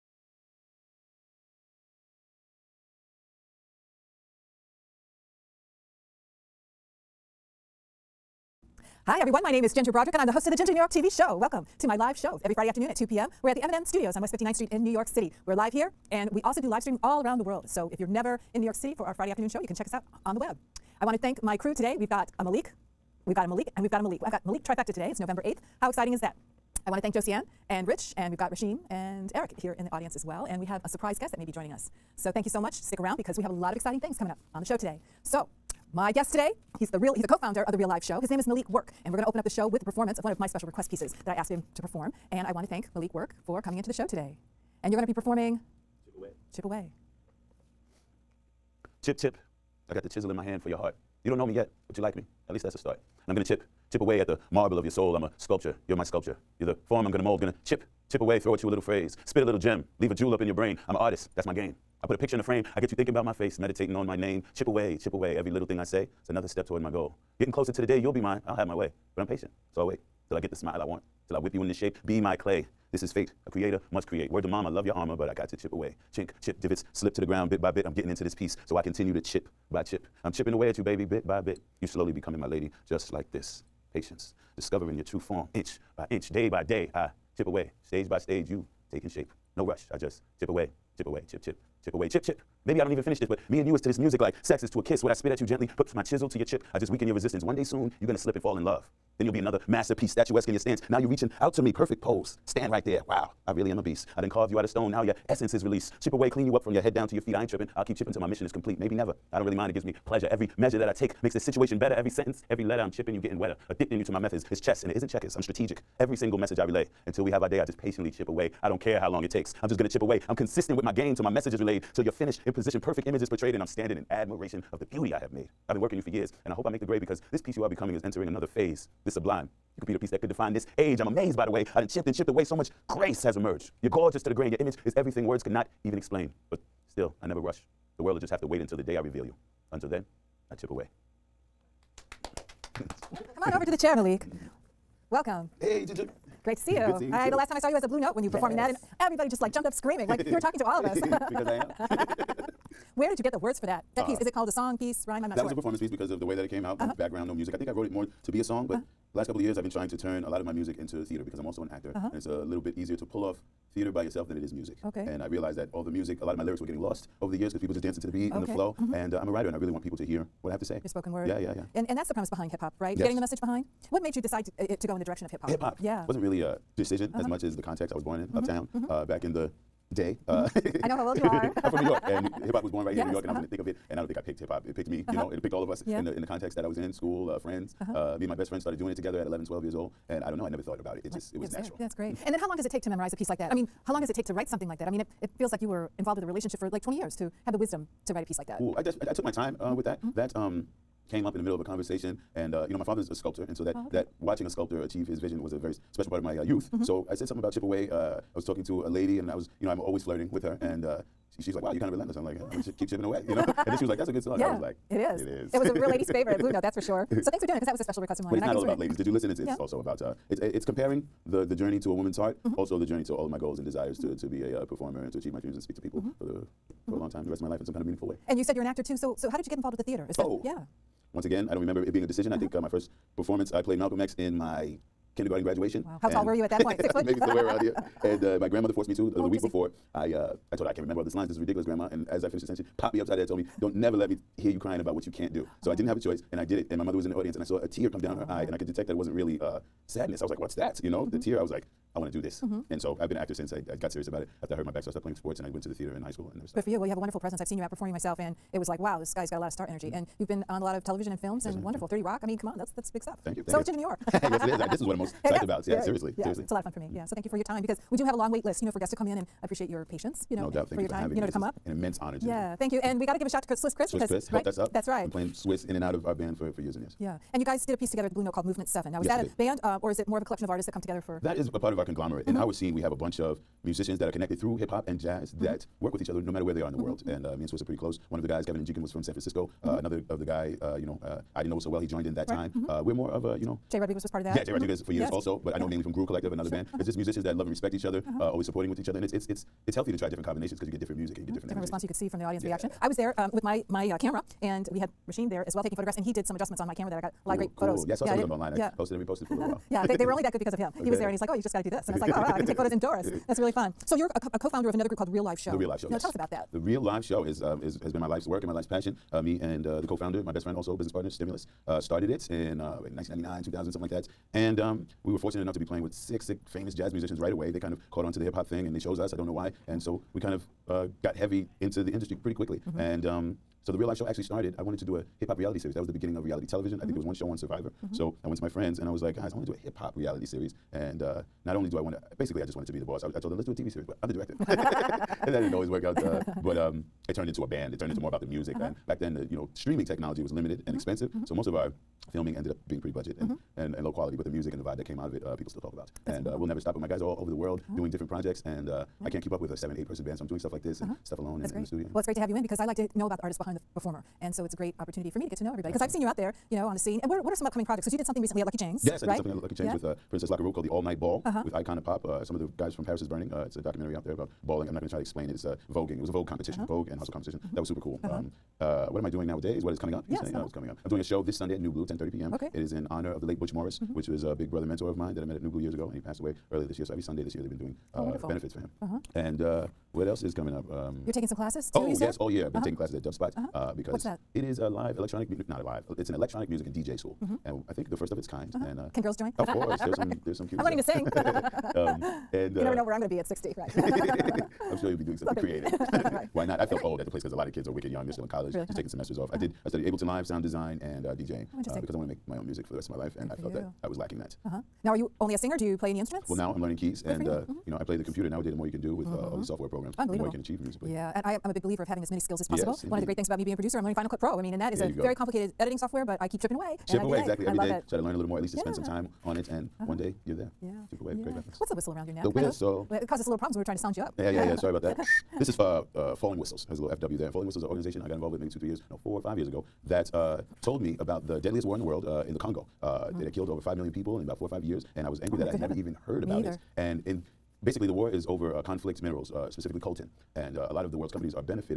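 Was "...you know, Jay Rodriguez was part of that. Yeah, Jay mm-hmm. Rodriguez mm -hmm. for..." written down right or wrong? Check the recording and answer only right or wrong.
right.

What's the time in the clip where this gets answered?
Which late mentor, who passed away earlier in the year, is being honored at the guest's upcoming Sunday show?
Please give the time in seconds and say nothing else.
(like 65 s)
383 s.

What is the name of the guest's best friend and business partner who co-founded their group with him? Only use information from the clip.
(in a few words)
Stimulus.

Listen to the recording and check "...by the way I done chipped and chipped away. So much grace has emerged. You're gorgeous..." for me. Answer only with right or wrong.
right.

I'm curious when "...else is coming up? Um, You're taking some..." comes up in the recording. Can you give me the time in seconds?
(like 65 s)
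390 s.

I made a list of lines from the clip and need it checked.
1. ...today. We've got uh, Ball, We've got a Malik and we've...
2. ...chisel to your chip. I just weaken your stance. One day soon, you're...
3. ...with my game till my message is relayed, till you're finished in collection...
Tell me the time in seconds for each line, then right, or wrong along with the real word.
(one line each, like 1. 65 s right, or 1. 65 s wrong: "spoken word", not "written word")
1. 21 s wrong: "Malik", not "Ball"
2. 96 s wrong: "resistance", not "stance"
3. 120 s wrong: "position", not "collection".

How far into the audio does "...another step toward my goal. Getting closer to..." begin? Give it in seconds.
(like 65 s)
66 s.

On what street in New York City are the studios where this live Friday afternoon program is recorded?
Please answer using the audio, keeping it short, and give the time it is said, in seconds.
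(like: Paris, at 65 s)
West 59th Street, at 14 s.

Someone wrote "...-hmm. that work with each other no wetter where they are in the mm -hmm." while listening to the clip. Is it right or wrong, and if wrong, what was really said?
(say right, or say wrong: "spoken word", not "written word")
wrong: "matter", not "wetter".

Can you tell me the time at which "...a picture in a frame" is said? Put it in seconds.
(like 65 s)
62 s.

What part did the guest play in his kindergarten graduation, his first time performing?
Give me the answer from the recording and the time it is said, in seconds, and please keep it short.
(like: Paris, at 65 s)
Malcolm X, at 233 s.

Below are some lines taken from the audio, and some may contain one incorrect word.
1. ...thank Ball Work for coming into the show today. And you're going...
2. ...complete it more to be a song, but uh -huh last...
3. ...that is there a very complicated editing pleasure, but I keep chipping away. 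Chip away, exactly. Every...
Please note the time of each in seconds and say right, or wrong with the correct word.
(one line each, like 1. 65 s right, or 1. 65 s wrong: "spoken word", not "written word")
1. 42 s wrong: "Malik", not "Ball"
2. 157 s wrong: "wrote", not "complete"
3. 424 s wrong: "software", not "pleasure".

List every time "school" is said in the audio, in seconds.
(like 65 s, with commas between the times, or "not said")
186 s, 256 s, 396 s.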